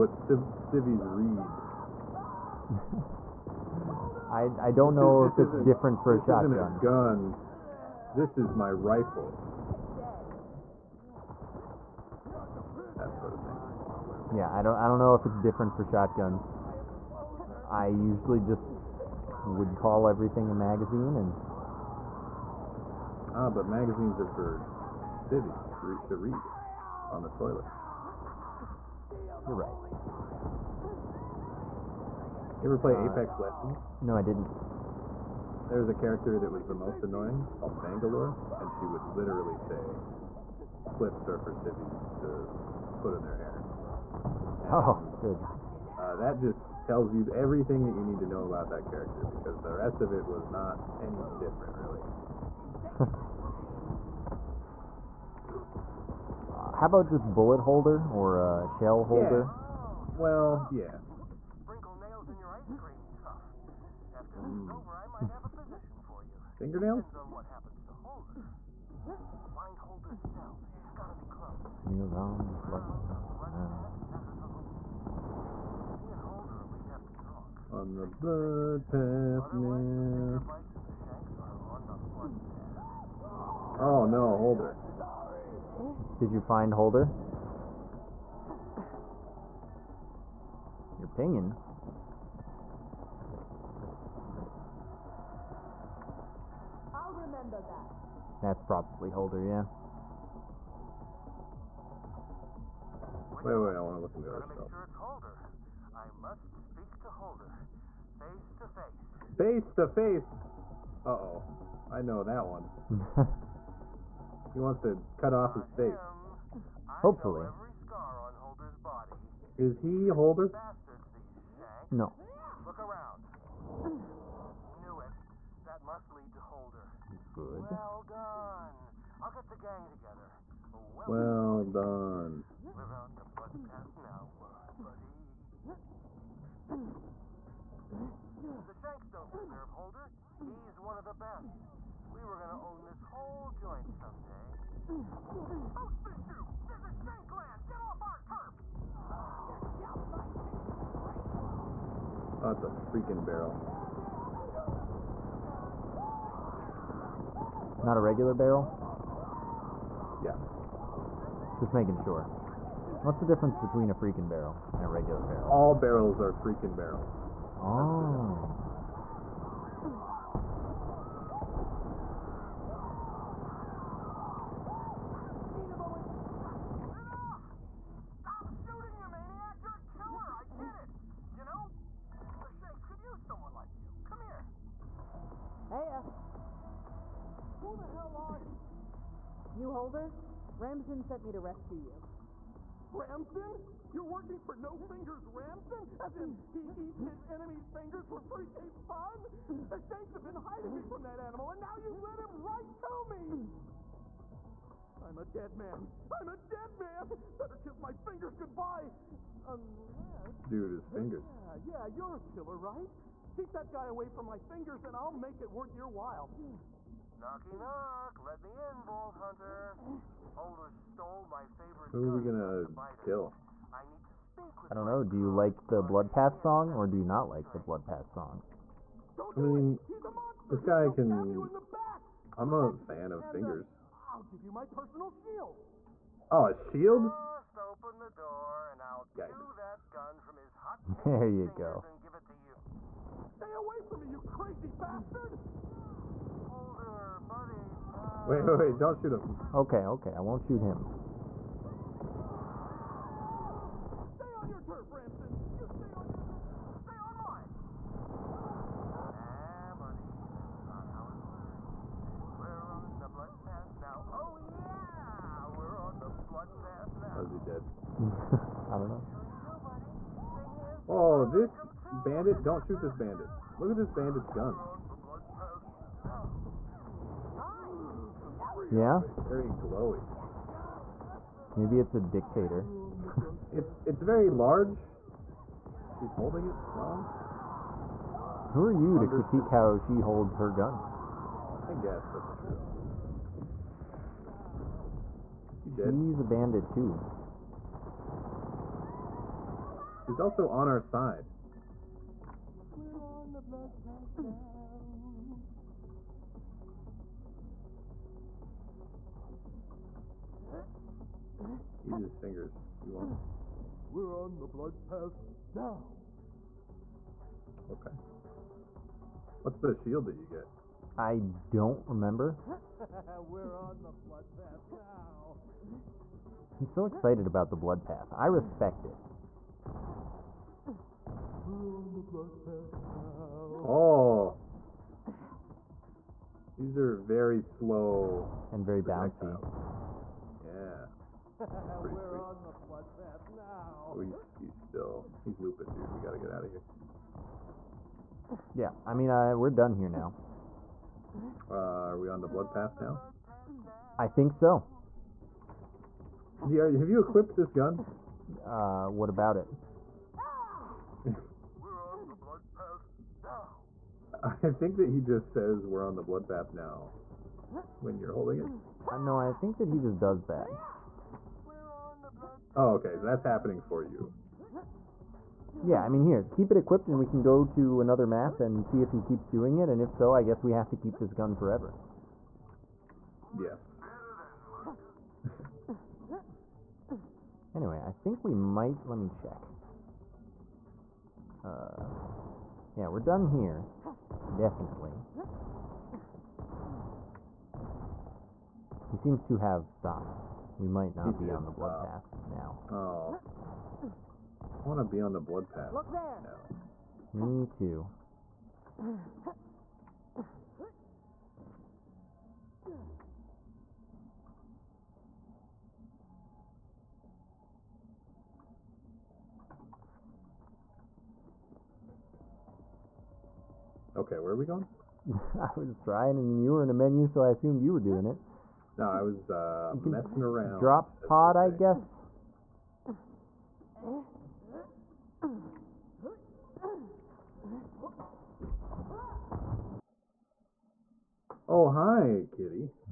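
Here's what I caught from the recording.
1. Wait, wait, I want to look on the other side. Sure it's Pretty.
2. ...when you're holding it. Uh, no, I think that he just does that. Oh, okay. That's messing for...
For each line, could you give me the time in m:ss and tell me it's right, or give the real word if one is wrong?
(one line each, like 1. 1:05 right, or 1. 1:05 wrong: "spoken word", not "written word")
1. 1:43 wrong: "Holder", not "Pretty"
2. 6:07 wrong: "happening", not "messing".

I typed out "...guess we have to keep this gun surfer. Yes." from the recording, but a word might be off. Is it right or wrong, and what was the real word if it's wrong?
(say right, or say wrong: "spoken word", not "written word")
wrong: "forever", not "surfer".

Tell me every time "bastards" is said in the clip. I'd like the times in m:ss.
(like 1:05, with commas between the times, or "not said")
2:00, 4:04.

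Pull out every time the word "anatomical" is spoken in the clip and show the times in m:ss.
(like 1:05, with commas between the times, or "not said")
not said.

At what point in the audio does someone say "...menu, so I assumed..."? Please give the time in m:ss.
7:06.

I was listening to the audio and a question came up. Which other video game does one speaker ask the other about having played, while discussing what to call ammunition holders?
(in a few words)
Apex Legends.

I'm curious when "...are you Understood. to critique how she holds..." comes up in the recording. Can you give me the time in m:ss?
4:48.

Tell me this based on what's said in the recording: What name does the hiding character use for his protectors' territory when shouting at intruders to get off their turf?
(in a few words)
Shankland.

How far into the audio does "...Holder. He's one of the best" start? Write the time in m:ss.
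2:19.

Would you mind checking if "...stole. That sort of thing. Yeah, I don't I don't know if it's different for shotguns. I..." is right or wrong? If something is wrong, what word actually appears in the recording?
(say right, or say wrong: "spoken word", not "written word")
wrong: "rifle", not "stole".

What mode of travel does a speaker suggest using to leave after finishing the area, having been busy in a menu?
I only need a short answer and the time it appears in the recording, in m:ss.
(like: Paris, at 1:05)
Drop pod, at 7:10.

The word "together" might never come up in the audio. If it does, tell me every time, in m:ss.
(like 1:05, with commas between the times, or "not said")
2:09.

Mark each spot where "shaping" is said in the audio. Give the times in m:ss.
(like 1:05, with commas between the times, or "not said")
not said.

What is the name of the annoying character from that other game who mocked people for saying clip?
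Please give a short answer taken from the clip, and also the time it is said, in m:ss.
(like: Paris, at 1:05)
Bangalore, at 0:37.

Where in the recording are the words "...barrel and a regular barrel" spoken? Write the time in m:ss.
2:44.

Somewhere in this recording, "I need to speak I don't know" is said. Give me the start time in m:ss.
3:43.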